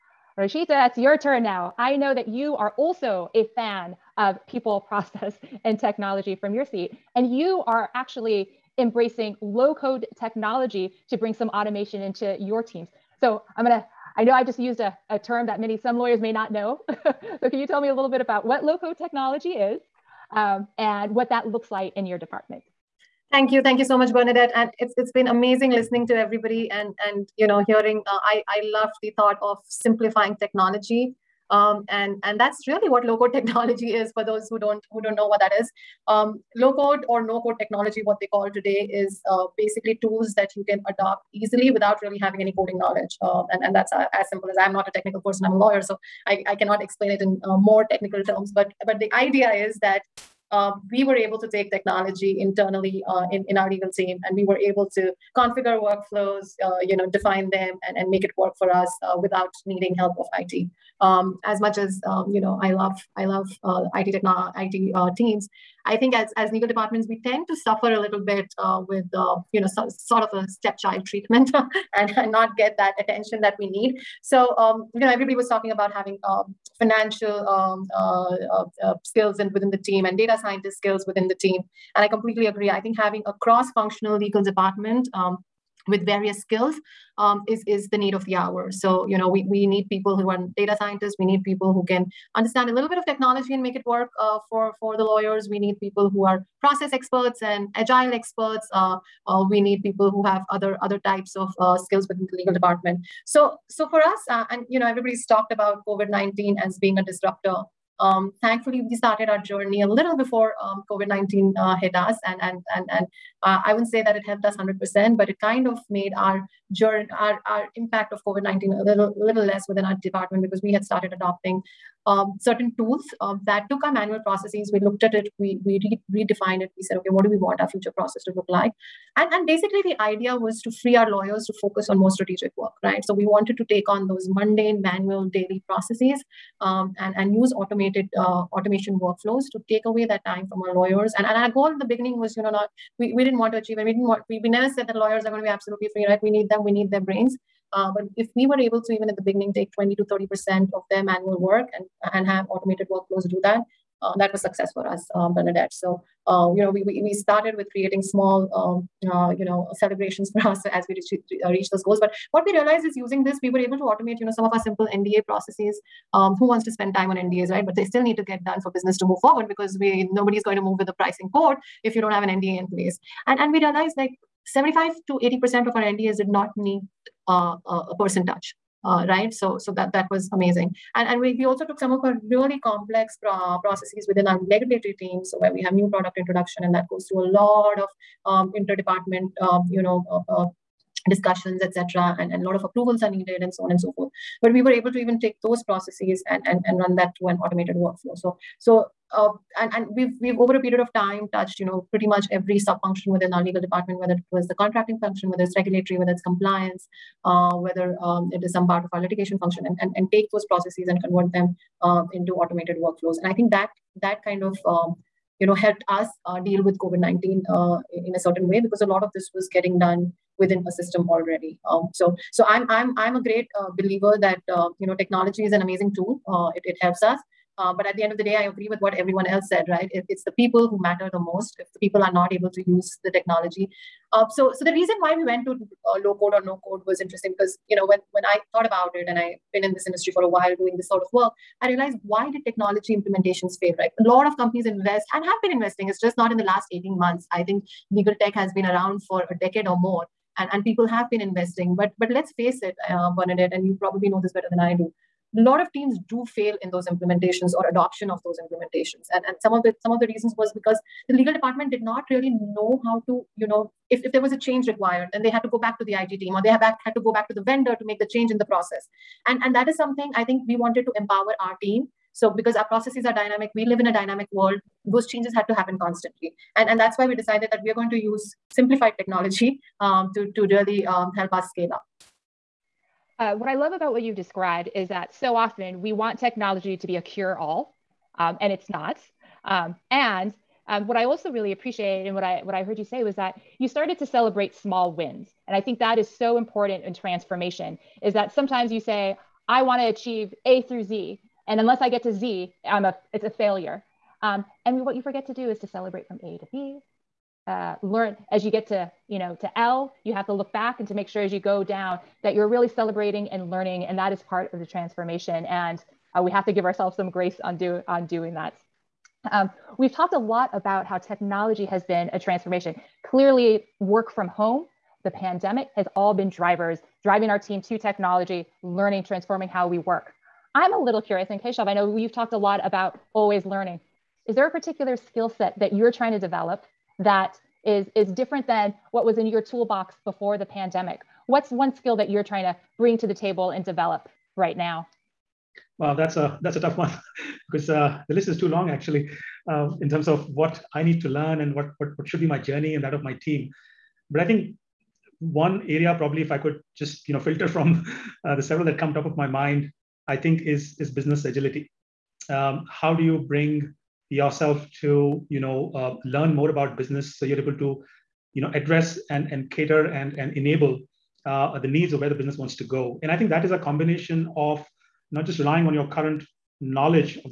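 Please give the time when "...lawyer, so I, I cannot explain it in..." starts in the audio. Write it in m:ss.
0:45.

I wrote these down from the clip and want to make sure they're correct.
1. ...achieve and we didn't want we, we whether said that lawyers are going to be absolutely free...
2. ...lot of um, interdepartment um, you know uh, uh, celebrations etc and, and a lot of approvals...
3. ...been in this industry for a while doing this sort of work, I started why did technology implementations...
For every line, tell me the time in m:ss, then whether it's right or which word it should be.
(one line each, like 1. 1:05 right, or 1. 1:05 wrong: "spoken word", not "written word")
1. 2:23 wrong: "never", not "whether"
2. 3:07 wrong: "discussions", not "celebrations"
3. 3:59 wrong: "realized", not "started".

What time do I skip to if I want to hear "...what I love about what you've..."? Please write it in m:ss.
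4:43.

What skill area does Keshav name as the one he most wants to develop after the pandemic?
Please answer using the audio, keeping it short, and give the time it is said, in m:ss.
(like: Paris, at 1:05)
business agility, at 6:00.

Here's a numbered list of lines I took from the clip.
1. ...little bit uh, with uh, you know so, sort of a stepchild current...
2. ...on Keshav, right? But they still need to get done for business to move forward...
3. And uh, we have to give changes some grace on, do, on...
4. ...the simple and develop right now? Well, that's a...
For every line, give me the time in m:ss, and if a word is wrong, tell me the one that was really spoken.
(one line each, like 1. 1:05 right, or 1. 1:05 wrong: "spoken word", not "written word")
1. 1:07 wrong: "treatment", not "current"
2. 2:47 wrong: "NDAs", not "Keshav"
3. 5:15 wrong: "ourselves", not "changes"
4. 5:43 wrong: "table", not "simple".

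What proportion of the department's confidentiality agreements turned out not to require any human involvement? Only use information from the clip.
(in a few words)
75 to 80%.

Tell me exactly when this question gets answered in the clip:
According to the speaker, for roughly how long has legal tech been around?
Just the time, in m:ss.
4:09.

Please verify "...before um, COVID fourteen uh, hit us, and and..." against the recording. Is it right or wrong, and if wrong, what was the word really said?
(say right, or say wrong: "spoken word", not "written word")
wrong: "nineteen", not "fourteen".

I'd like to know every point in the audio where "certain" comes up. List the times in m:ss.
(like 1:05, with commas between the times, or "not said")
2:02, 3:38.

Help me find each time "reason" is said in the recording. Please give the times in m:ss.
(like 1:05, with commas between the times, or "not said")
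3:54, 4:20.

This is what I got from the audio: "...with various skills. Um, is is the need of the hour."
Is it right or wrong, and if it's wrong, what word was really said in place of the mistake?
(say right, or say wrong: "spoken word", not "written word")
right.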